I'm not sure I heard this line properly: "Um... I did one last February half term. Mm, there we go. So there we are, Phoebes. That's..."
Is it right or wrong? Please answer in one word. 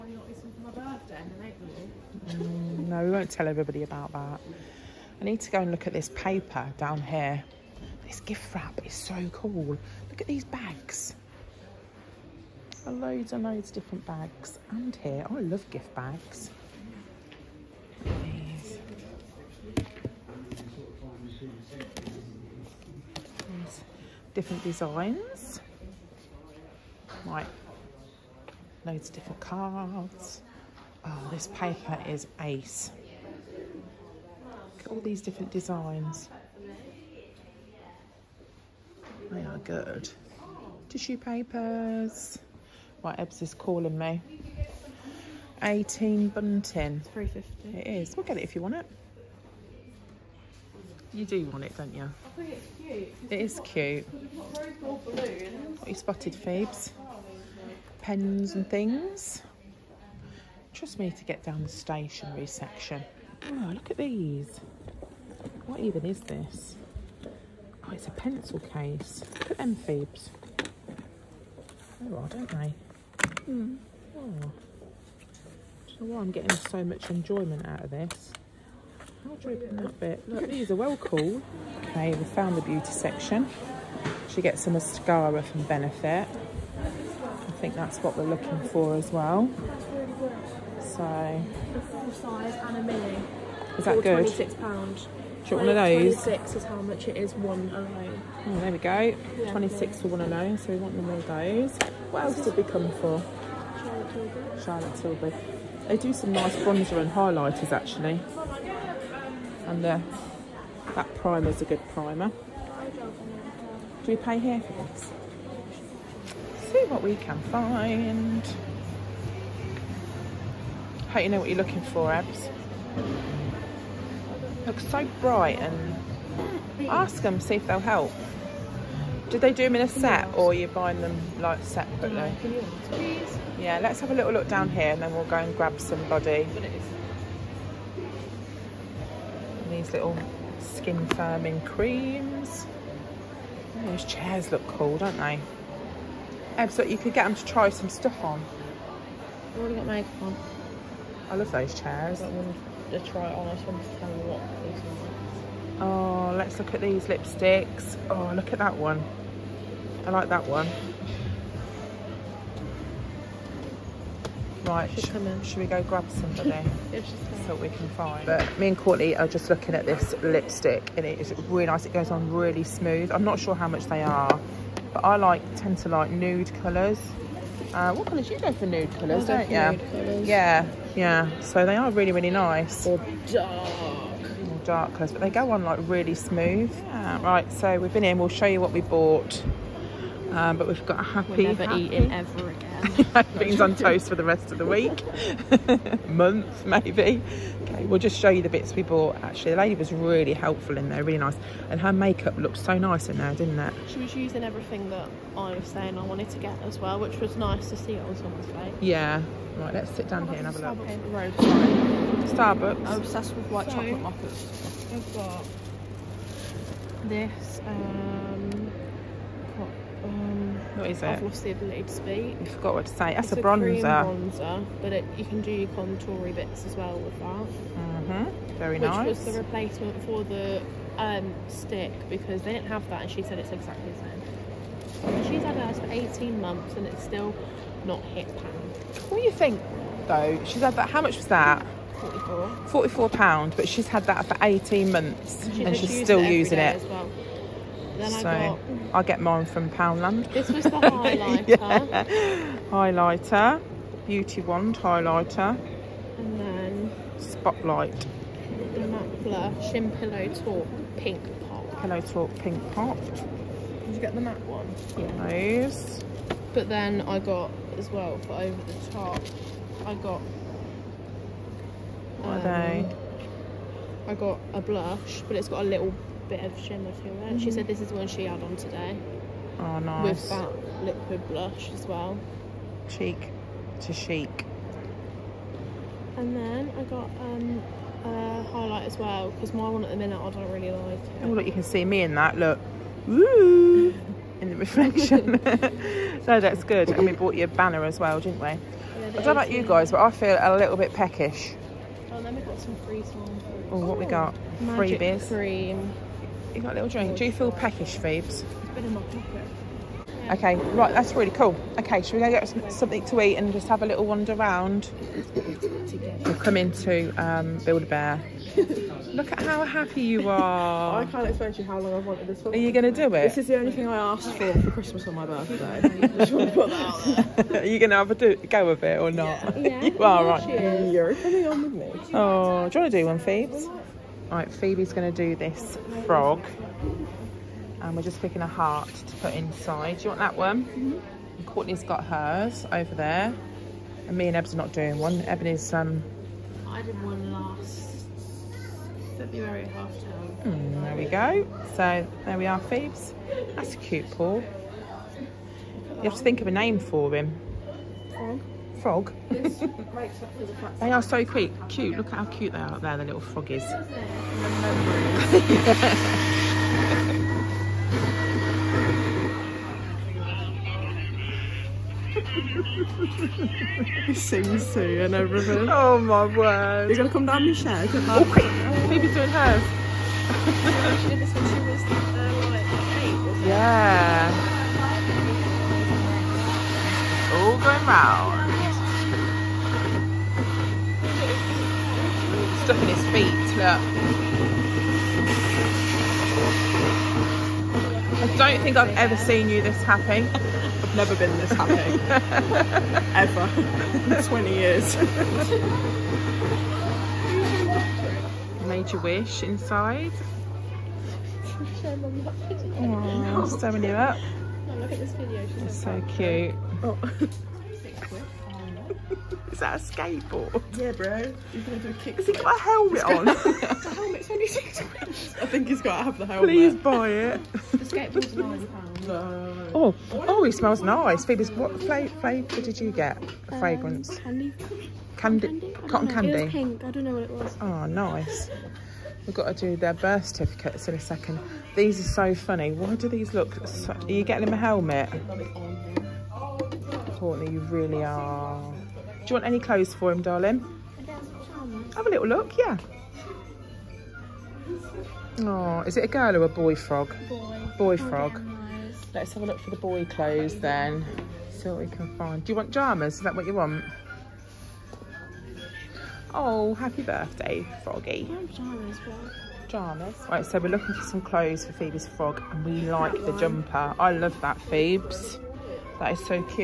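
right.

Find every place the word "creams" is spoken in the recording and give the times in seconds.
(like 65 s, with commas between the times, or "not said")
141 s, 305 s.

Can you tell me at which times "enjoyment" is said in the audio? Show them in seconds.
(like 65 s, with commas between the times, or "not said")
77 s.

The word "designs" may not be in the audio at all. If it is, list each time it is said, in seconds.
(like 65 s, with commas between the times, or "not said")
24 s, 35 s.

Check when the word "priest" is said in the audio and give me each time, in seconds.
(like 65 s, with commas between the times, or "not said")
not said.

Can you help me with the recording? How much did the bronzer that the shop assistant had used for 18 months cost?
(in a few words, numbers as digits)
£44.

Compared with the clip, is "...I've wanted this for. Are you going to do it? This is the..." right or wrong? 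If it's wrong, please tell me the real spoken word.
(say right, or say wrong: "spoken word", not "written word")
right.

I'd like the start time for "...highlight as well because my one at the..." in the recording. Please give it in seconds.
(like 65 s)
288 s.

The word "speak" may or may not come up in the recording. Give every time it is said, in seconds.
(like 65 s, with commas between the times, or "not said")
221 s.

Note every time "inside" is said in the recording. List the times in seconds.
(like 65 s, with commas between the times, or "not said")
339 s, 409 s.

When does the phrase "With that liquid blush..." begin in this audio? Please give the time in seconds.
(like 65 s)
280 s.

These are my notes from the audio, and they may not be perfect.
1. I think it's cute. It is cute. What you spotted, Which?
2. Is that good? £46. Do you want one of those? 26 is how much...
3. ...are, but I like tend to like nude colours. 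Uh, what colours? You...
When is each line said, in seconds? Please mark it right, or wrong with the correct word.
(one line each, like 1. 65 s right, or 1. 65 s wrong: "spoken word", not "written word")
1. 52 s wrong: "Phoebes", not "Which"
2. 93 s wrong: "26", not "46"
3. 174 s right.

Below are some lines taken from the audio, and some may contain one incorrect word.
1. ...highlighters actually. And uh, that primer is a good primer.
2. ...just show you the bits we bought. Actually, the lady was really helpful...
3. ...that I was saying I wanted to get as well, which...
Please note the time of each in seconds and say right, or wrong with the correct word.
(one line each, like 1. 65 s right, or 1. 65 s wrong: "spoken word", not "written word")
1. 107 s right
2. 197 s right
3. 204 s right.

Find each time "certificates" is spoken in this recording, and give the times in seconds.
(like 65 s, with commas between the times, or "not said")
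440 s.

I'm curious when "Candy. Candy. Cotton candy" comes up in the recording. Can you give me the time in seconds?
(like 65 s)
434 s.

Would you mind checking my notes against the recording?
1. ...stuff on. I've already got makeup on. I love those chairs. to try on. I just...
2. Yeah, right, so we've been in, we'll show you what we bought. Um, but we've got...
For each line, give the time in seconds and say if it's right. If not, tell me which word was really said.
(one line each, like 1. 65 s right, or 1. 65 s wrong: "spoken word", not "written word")
1. 147 s right
2. 186 s right.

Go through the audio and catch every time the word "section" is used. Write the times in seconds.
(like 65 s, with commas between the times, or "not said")
62 s, 82 s.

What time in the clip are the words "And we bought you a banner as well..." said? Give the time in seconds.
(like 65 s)
296 s.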